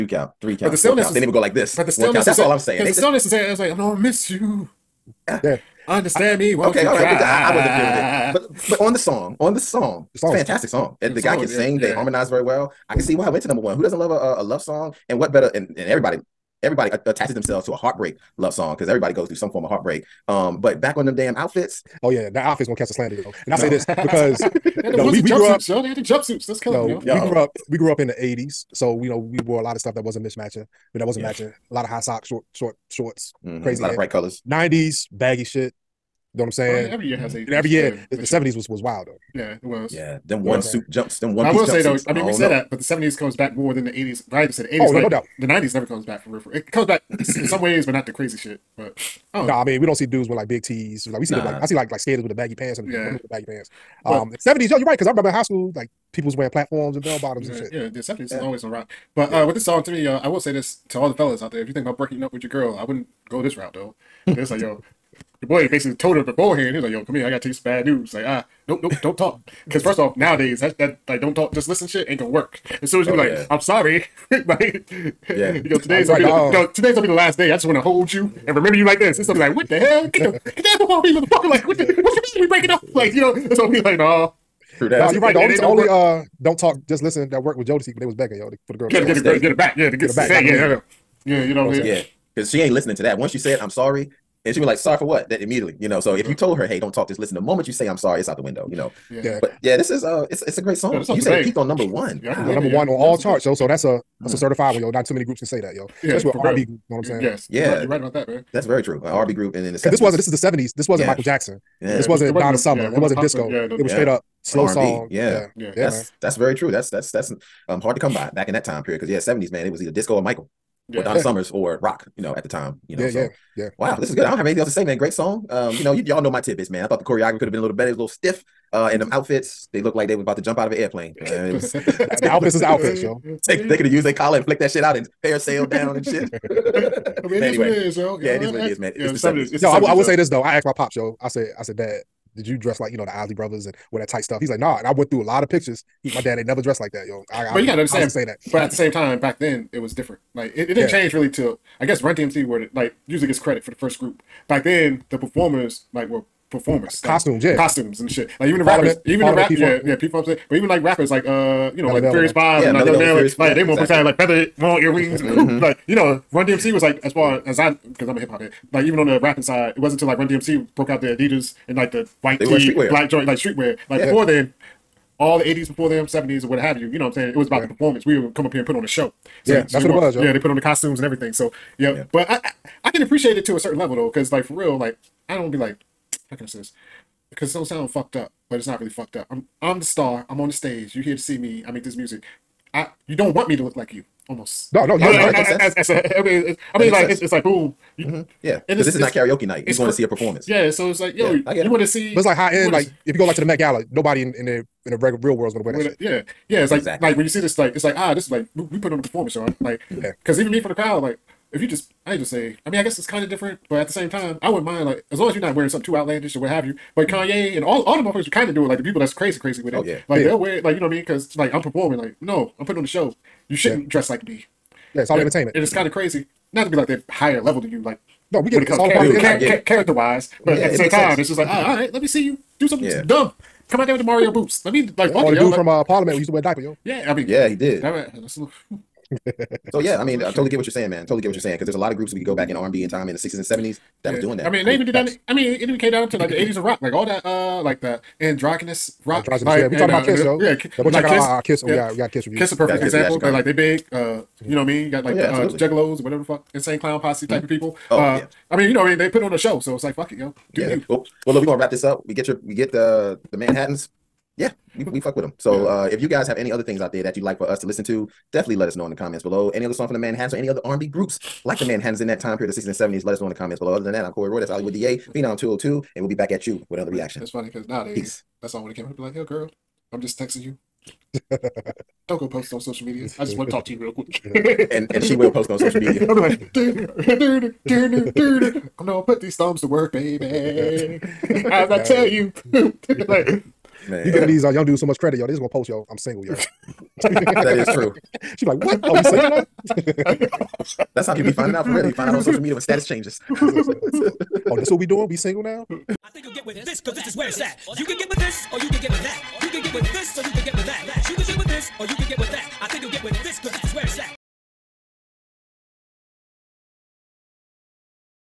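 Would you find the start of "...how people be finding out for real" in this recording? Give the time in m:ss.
5:01.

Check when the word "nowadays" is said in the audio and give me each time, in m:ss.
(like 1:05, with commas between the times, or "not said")
1:10, 4:37.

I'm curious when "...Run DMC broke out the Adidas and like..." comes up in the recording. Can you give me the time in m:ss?
2:50.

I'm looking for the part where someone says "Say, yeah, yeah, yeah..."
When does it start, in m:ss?
1:30.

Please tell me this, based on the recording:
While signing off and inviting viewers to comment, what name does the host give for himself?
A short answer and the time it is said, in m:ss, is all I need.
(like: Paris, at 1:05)
Corey Roy, at 4:34.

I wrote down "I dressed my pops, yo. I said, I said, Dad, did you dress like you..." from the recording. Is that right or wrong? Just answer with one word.
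wrong.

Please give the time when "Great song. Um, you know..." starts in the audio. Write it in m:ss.
2:04.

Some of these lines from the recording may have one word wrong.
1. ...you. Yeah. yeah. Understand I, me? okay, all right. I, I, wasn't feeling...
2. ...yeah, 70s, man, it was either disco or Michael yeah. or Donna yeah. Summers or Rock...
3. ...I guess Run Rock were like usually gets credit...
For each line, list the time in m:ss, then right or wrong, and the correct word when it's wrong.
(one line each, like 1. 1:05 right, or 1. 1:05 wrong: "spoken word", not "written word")
1. 0:04 right
2. 1:59 right
3. 2:31 wrong: "DMC", not "Rock".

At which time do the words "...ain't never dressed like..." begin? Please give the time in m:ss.
2:26.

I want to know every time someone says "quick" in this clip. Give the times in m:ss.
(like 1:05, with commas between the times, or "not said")
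4:43.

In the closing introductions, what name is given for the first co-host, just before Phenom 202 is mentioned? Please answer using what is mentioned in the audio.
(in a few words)
Hollywood DA.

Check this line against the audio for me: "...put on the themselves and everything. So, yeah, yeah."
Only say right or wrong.
wrong.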